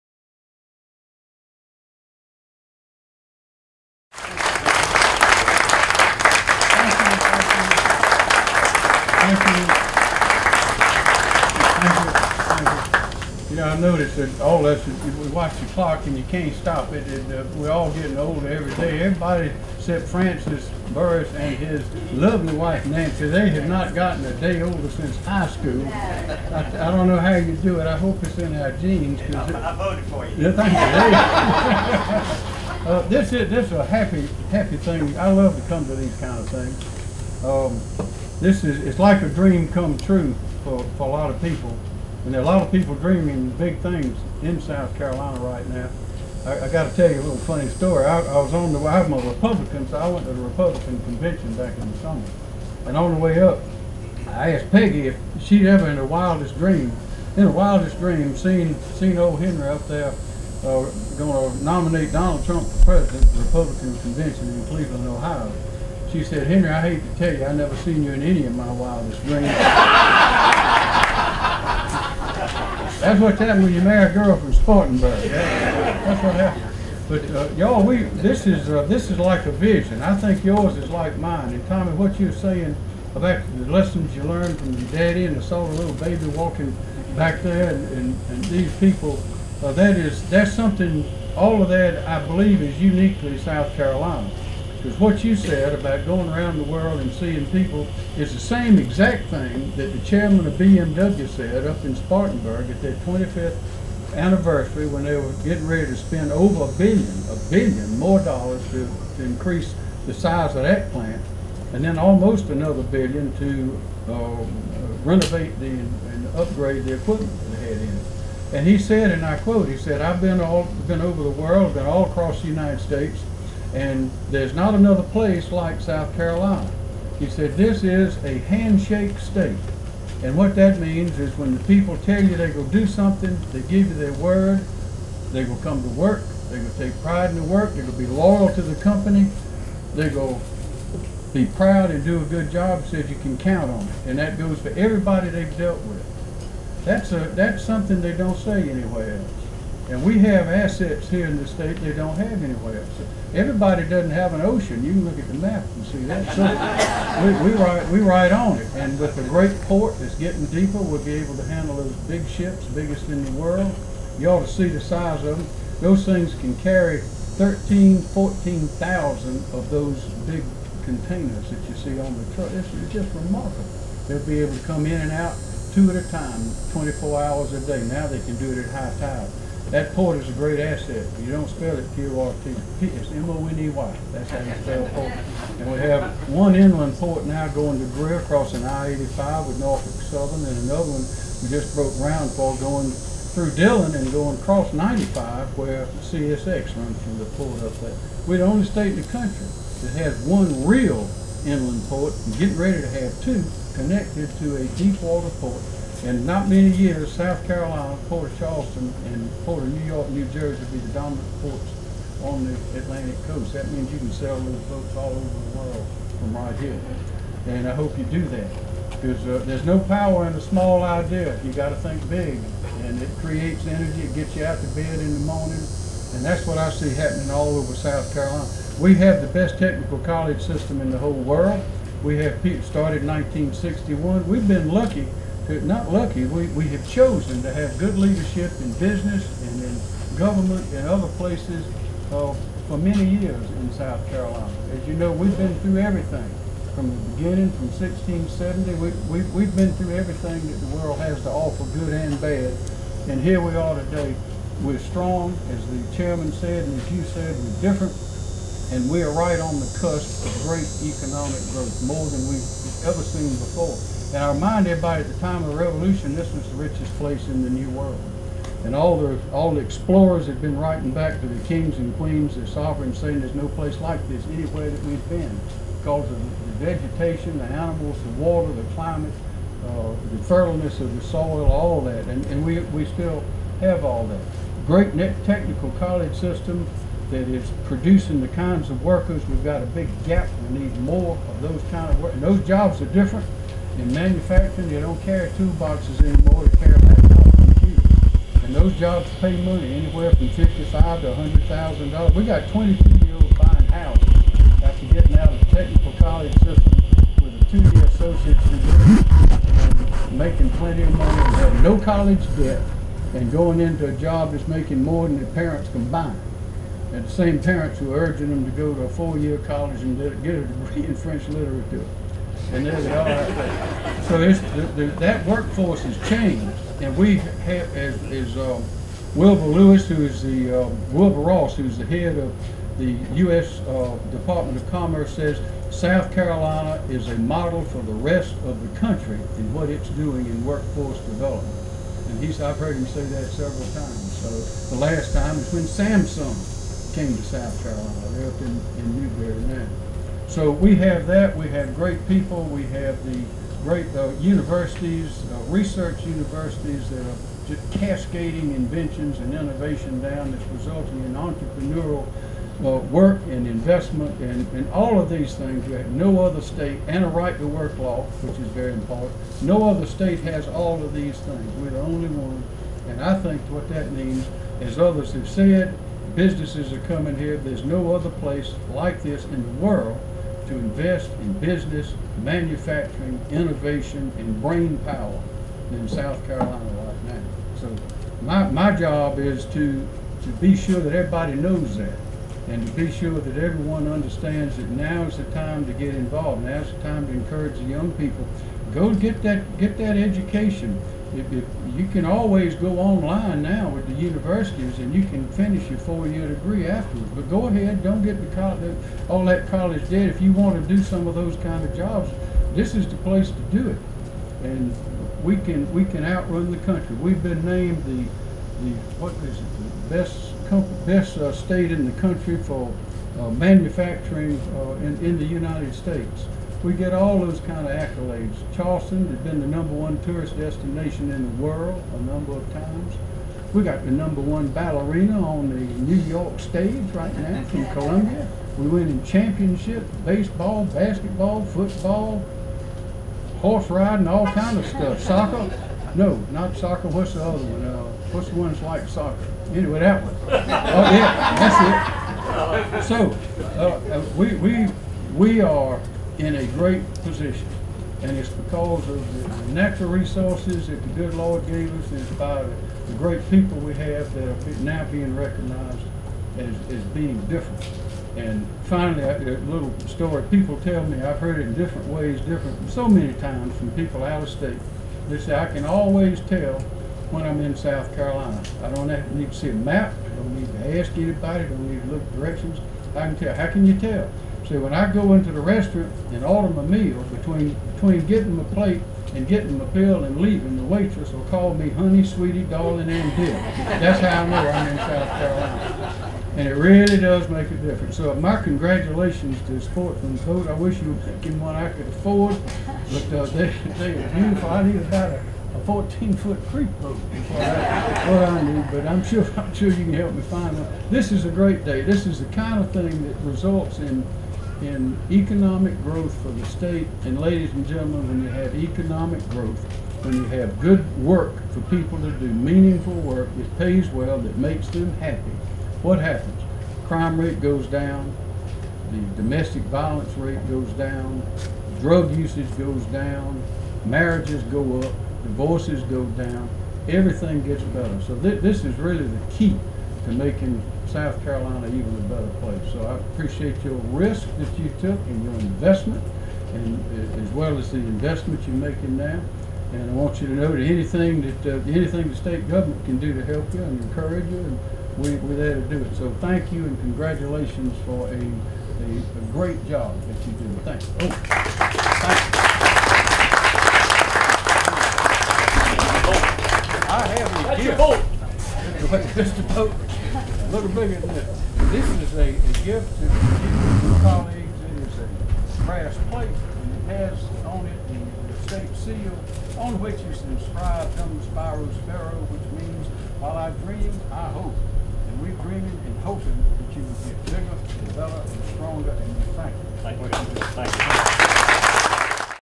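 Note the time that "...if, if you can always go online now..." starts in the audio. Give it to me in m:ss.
6:41.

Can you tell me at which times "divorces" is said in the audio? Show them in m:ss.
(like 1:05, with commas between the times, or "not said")
8:55.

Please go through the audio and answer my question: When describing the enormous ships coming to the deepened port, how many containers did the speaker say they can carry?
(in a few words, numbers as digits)
13,000-14,000.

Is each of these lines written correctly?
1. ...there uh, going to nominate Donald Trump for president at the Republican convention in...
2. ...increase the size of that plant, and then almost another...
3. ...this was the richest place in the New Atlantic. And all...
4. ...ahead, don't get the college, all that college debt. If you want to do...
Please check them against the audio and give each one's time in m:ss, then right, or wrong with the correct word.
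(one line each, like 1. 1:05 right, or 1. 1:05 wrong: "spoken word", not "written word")
1. 0:59 right
2. 1:49 right
3. 4:26 wrong: "World", not "Atlantic"
4. 6:47 right.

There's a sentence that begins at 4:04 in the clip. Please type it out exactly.
As you know, we've been through everything from the beginning, from 1670.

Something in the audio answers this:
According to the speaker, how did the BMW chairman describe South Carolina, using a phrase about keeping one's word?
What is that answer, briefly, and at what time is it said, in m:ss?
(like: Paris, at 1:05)
a handshake state, at 2:08.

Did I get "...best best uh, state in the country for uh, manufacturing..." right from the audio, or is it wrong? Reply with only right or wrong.
right.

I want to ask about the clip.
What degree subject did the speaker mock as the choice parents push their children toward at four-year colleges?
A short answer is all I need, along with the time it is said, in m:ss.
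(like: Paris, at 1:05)
French literature, at 5:20.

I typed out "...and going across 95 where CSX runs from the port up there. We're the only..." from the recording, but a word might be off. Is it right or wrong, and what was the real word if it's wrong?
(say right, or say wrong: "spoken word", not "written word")
right.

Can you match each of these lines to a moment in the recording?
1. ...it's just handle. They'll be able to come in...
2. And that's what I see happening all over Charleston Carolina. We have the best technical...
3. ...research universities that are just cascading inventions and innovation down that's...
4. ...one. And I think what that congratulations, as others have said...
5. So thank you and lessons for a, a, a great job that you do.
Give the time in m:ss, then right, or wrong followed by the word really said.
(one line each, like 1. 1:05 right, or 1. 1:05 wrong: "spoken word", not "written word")
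1. 2:52 wrong: "remarkable", not "handle"
2. 3:46 wrong: "South", not "Charleston"
3. 5:55 right
4. 6:12 wrong: "means", not "congratulations"
5. 9:15 wrong: "congratulations", not "lessons".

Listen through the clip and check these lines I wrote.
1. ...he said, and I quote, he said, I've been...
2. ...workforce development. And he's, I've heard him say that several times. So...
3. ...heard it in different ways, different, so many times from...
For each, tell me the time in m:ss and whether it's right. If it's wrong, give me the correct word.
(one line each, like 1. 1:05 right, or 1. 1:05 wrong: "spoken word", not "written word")
1. 1:58 right
2. 5:40 right
3. 7:51 right.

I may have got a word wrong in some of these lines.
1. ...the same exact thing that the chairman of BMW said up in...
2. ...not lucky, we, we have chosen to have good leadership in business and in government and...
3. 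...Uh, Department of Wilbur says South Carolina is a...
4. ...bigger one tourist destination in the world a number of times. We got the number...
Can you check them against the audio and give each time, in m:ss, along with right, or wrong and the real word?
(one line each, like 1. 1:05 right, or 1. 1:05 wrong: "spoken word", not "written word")
1. 1:38 right
2. 3:55 right
3. 5:33 wrong: "Commerce", not "Wilbur"
4. 7:09 wrong: "number", not "bigger".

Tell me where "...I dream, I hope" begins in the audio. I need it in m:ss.
9:43.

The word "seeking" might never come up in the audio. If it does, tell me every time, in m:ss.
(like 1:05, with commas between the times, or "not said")
not said.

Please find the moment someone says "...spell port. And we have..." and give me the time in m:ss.
3:04.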